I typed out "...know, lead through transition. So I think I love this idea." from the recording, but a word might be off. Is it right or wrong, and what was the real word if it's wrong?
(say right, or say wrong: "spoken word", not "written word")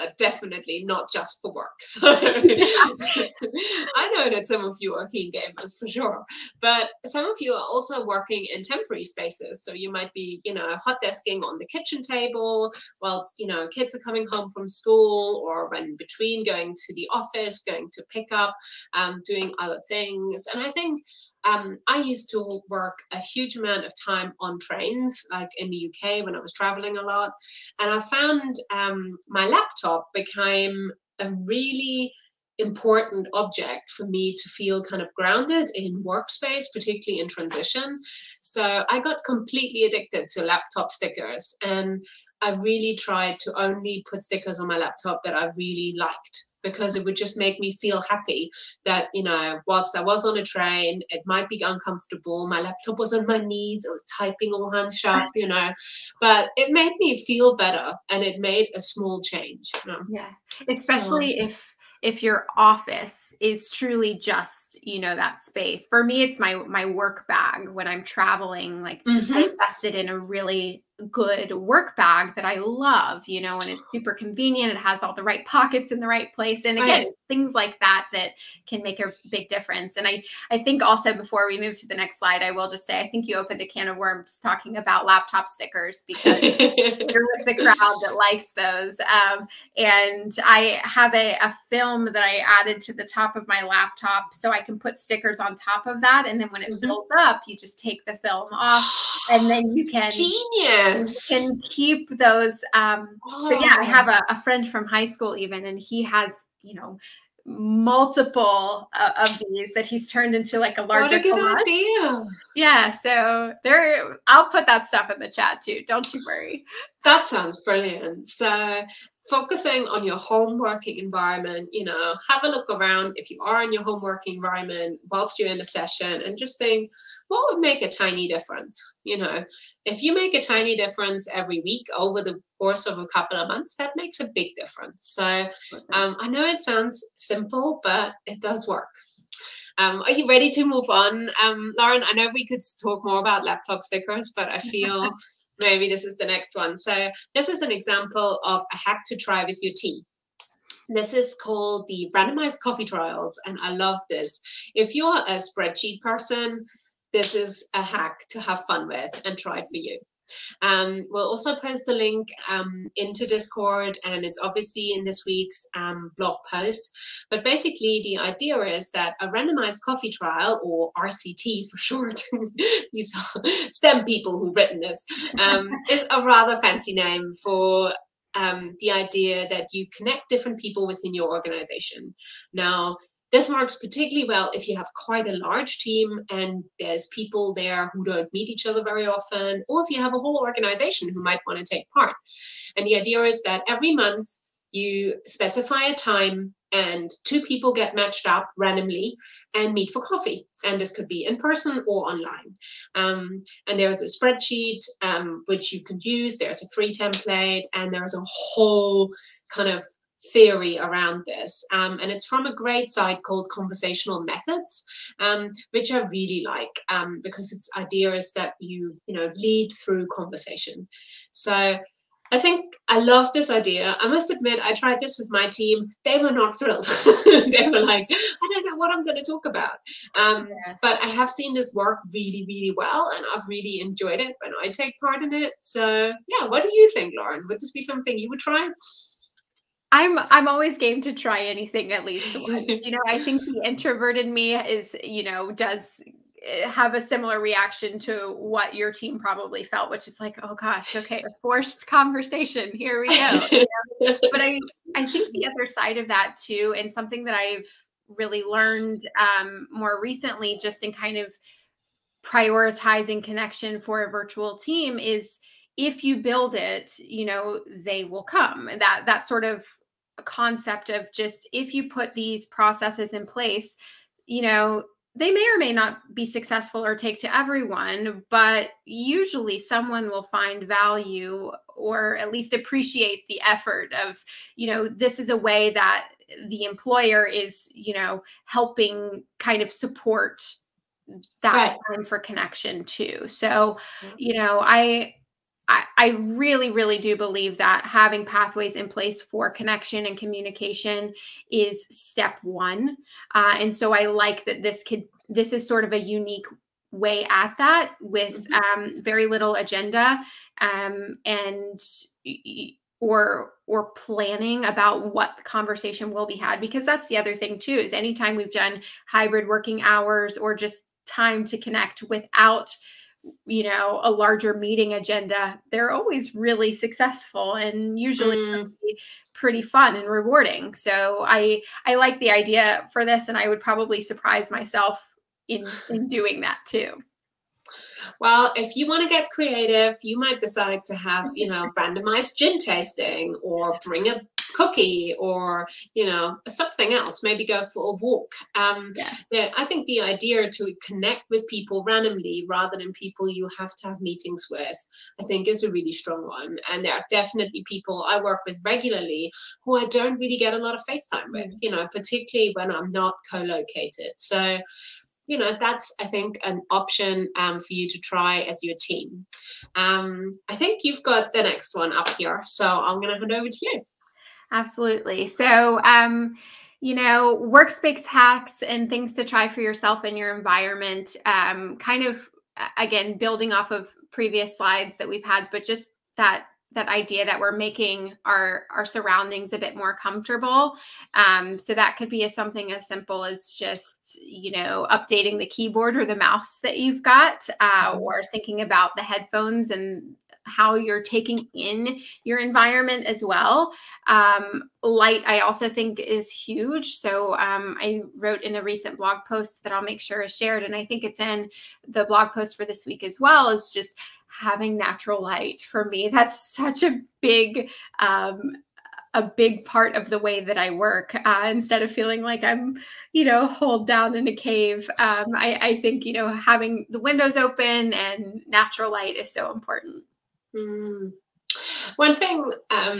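wrong: "conversation", not "transition".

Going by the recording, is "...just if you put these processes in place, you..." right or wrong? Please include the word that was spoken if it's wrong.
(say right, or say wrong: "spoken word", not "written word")
right.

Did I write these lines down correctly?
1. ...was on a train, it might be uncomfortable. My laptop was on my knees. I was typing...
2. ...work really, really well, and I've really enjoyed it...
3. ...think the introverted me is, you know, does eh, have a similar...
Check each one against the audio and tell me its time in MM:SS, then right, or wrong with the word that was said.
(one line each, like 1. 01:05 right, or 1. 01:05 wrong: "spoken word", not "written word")
1. 00:50 right
2. 03:51 right
3. 04:03 right.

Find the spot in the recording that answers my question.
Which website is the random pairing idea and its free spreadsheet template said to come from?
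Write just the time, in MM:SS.
03:33.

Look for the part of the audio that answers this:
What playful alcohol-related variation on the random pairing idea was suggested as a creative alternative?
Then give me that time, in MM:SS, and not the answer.
05:41.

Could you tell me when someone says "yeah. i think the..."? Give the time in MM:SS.
05:49.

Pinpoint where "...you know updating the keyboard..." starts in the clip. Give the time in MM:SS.
06:34.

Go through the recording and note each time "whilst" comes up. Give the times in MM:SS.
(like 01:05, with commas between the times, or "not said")
00:13, 00:49, 02:05.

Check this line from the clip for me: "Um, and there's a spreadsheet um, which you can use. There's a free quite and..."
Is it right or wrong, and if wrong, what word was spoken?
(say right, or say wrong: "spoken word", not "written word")
wrong: "template", not "quite".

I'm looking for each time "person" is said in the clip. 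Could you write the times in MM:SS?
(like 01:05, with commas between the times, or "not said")
02:35, 03:21.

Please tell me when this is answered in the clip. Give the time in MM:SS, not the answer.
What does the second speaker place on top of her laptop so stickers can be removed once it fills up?
01:31.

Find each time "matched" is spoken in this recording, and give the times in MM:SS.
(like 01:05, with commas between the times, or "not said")
03:17.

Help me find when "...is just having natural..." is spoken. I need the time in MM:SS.
06:53.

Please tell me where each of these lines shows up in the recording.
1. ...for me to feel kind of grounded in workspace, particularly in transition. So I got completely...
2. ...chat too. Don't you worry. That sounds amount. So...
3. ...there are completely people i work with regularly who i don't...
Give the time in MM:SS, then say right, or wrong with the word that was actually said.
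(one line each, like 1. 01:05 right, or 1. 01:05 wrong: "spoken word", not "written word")
1. 00:33 right
2. 01:55 wrong: "brilliant", not "amount"
3. 05:56 wrong: "definitely", not "completely".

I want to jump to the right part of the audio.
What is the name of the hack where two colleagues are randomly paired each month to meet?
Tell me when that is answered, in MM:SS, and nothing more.
02:32.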